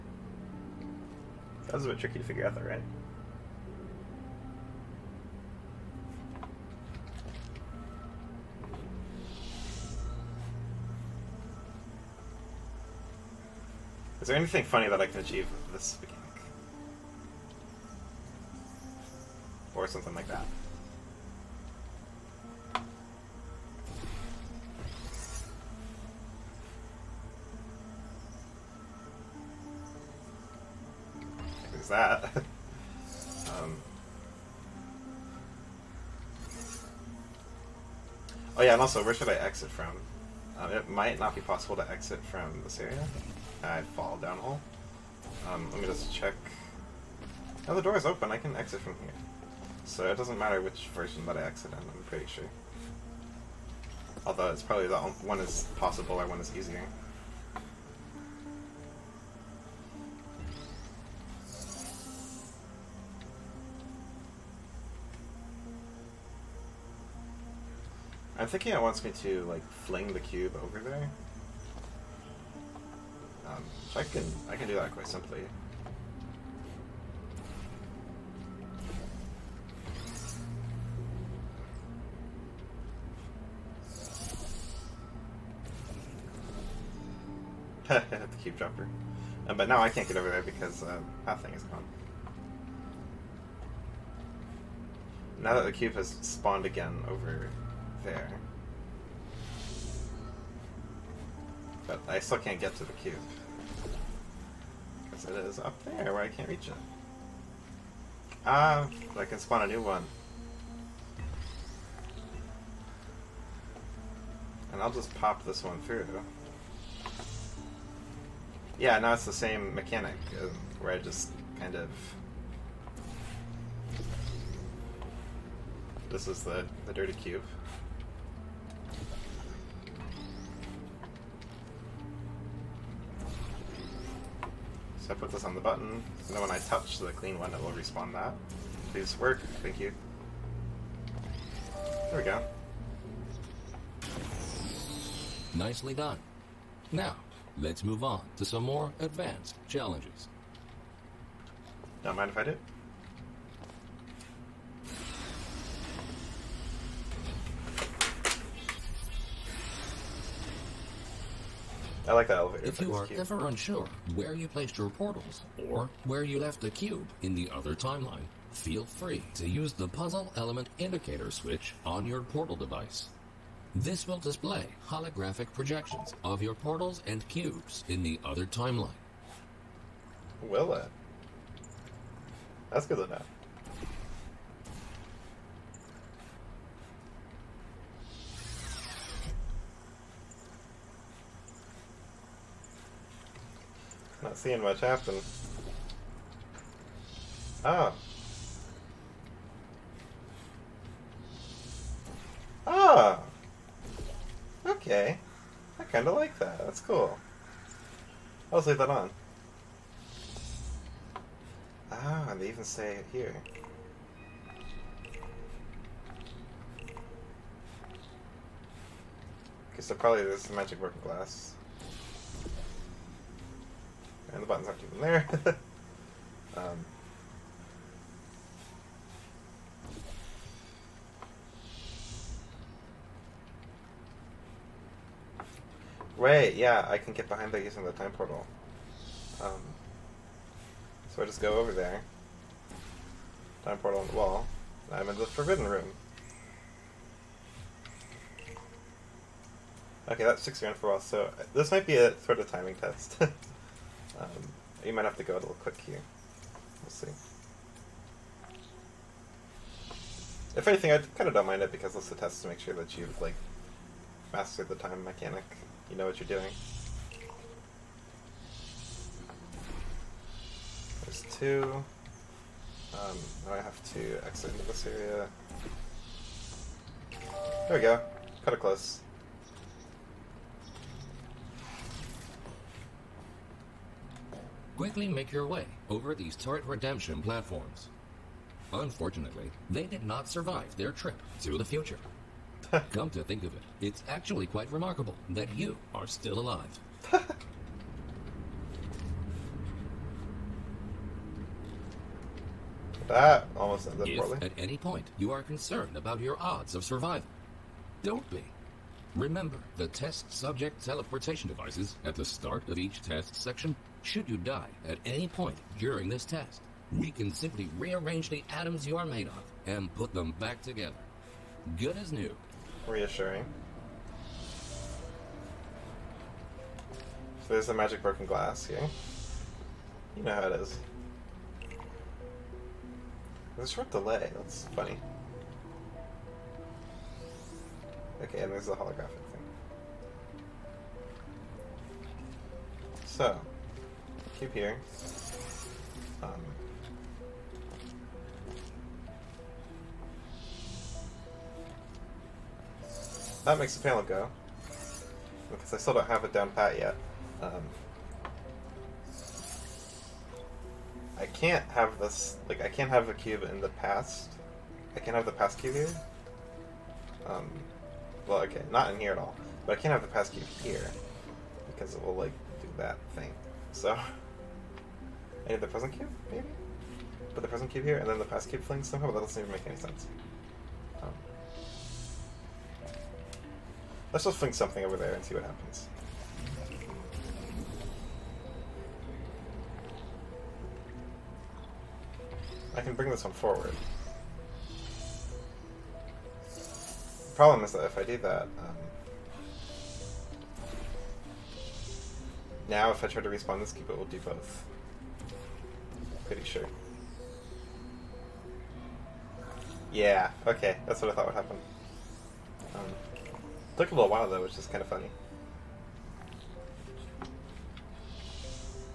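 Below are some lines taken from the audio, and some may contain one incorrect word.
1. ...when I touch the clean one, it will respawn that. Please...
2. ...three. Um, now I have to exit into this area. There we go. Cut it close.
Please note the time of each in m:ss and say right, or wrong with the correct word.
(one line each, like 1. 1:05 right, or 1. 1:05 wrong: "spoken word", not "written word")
1. 2:16 right
2. 4:31 wrong: "two", not "three".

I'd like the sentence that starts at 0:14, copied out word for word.
Is there anything funny that I can achieve with this or something like that.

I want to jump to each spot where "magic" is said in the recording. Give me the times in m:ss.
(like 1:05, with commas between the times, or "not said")
3:40, 5:27.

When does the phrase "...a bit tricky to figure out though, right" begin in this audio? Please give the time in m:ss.
0:01.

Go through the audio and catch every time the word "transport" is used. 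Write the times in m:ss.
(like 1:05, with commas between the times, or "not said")
not said.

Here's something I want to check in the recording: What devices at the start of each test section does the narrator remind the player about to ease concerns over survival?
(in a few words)
Test subject teleportation devices.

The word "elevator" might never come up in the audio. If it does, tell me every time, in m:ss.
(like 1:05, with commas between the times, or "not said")
2:42.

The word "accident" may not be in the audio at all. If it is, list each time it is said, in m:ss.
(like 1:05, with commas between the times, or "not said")
0:51.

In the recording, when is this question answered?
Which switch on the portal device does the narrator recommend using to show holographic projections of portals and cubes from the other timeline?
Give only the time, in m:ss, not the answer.
2:49.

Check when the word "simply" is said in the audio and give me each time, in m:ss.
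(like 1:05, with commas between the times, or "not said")
1:15, 5:17.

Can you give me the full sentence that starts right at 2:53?
This will display holographic projections of your portals and cubes in the other timeline.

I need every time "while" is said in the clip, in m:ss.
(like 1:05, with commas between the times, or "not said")
4:10, 6:54.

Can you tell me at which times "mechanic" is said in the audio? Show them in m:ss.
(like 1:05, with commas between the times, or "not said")
1:59, 4:25.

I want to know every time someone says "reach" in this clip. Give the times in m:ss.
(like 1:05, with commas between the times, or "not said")
1:46.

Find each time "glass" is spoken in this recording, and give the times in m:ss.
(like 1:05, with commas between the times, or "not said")
3:41, 5:28.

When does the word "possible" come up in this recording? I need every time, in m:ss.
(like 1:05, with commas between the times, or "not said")
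0:41, 0:55.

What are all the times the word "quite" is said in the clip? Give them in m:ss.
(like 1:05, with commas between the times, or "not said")
1:14, 4:54.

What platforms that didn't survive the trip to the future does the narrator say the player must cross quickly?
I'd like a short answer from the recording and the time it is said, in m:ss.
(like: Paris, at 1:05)
Turret redemption platforms, at 4:46.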